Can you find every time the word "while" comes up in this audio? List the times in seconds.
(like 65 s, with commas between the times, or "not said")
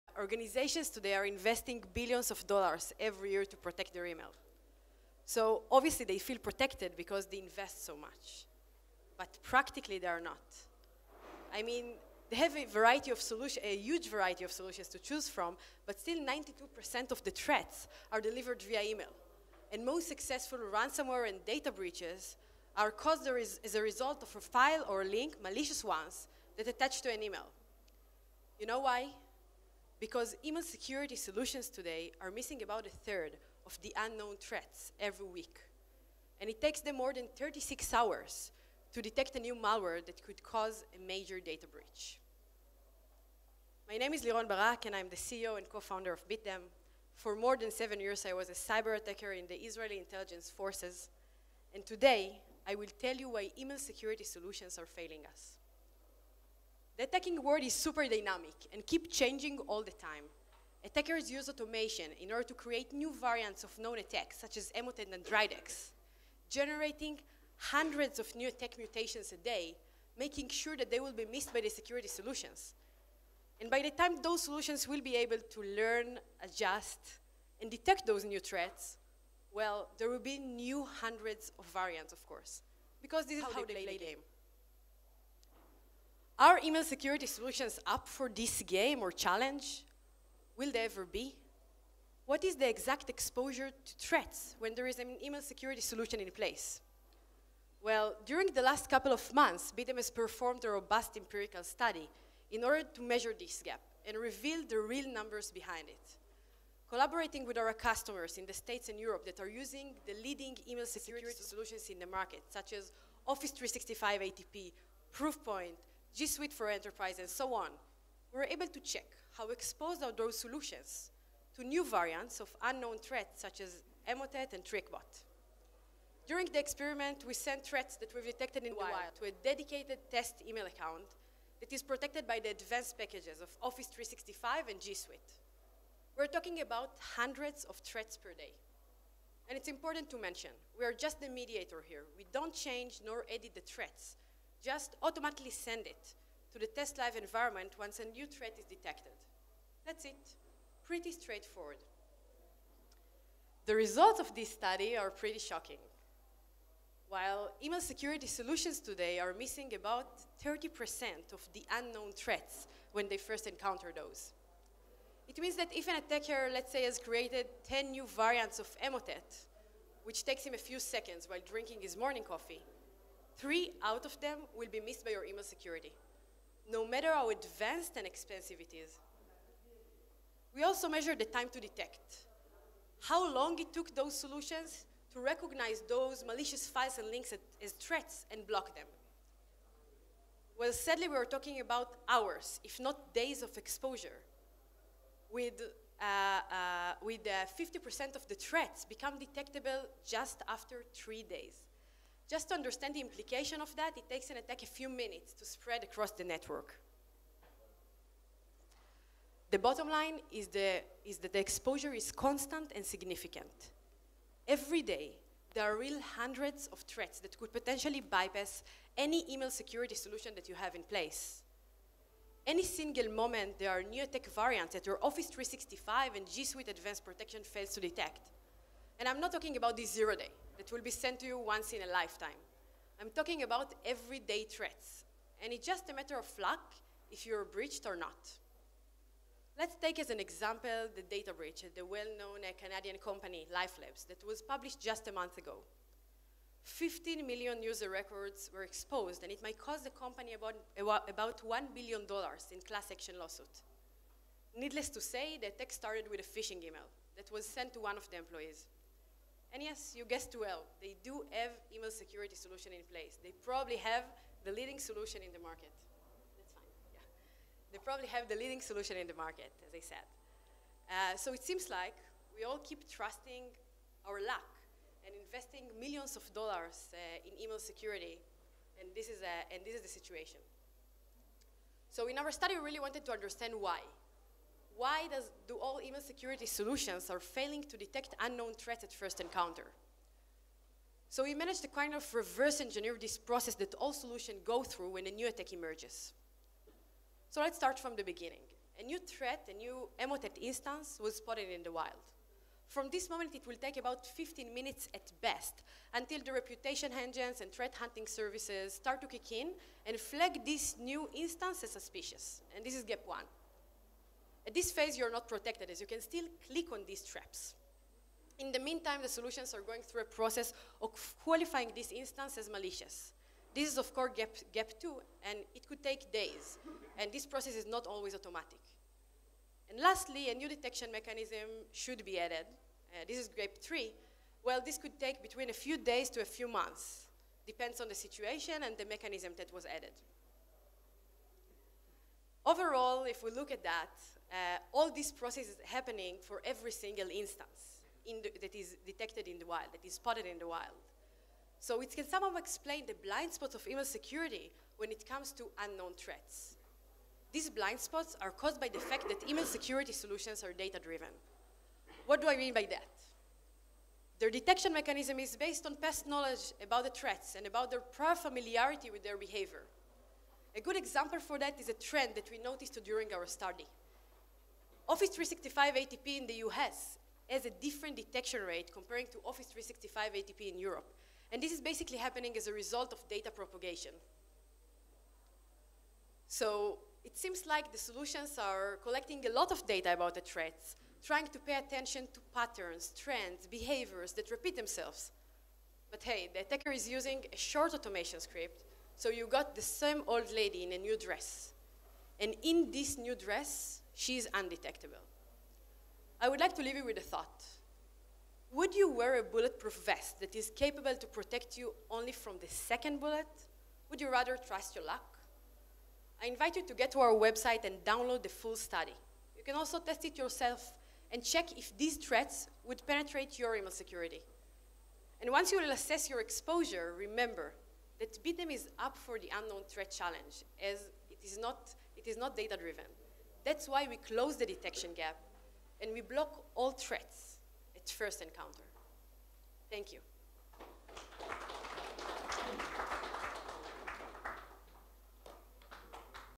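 157 s, 171 s.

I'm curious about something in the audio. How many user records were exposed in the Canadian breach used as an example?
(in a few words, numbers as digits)
15 million.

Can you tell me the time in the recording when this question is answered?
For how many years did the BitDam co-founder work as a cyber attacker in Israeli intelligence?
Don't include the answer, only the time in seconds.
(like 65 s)
47 s.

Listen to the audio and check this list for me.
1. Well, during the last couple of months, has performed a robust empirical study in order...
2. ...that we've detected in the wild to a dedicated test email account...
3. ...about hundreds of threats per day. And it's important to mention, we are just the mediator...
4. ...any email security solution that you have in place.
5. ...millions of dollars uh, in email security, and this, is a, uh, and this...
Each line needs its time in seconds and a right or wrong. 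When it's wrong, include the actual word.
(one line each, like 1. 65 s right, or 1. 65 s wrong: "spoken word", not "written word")
1. 97 s right
2. 127 s right
3. 136 s right
4. 218 s right
5. 275 s right.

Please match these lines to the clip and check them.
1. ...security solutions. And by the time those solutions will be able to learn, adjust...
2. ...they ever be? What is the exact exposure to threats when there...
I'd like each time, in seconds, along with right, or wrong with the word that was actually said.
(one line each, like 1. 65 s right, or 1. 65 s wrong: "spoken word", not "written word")
1. 71 s right
2. 90 s right.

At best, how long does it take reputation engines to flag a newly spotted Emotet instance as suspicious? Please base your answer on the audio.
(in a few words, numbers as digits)
15 minutes.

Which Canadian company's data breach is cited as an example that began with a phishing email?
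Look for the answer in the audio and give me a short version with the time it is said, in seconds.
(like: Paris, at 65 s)
LifeLabs, at 243 s.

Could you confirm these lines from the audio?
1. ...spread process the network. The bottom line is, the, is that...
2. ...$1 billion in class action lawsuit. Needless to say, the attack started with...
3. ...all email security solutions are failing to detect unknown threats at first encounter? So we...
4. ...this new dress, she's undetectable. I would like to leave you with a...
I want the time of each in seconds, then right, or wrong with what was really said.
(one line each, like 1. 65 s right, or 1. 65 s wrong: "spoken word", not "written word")
1. 205 s wrong: "across", not "process"
2. 251 s right
3. 285 s right
4. 402 s right.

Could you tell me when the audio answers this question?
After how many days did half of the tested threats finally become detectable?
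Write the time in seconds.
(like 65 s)
200 s.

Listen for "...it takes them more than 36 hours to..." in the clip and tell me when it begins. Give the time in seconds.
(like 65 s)
36 s.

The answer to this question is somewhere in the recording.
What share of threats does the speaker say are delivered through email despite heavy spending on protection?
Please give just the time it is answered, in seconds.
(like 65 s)
16 s.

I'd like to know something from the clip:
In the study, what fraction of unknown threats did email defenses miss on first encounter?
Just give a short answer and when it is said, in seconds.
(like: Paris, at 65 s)
30%, at 160 s.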